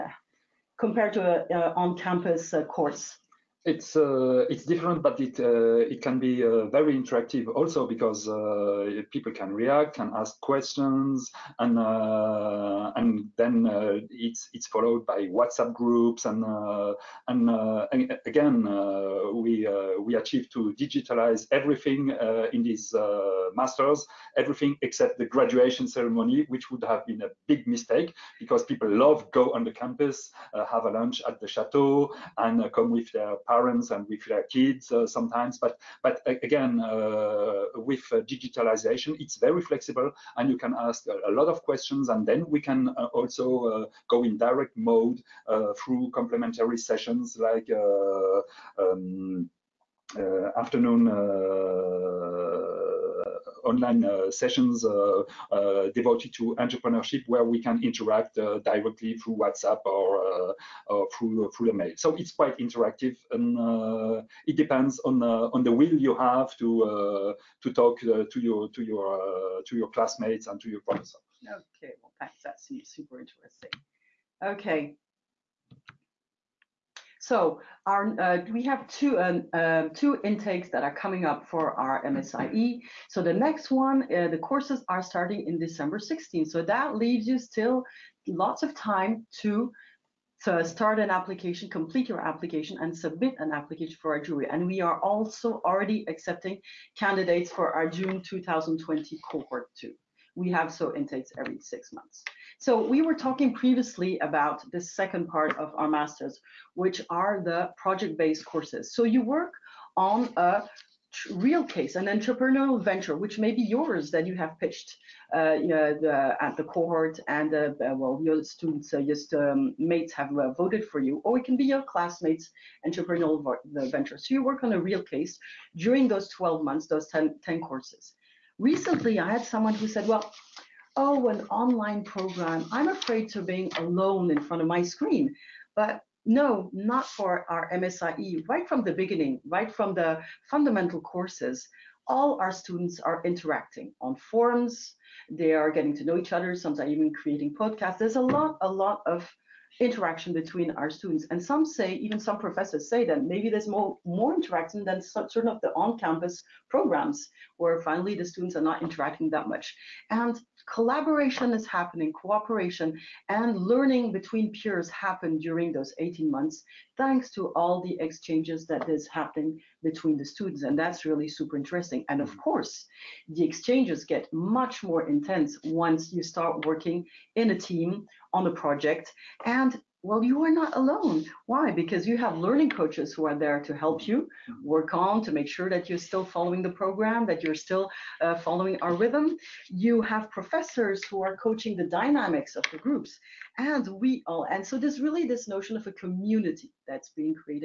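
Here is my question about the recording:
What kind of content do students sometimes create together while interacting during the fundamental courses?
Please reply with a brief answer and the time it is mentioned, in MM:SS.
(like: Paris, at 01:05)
Podcasts, at 02:27.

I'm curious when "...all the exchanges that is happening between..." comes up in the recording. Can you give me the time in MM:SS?
02:47.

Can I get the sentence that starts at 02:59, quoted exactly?
And well, you are not alone.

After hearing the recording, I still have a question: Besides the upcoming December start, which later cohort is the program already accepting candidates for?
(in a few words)
June 2020.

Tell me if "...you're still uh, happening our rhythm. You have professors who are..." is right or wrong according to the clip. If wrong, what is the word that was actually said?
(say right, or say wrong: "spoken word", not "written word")
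wrong: "following", not "happening".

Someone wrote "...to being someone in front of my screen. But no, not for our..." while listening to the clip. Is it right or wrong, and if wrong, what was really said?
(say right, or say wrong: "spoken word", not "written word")
wrong: "alone", not "someone".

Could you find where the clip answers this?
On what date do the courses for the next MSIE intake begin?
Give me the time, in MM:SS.
01:25.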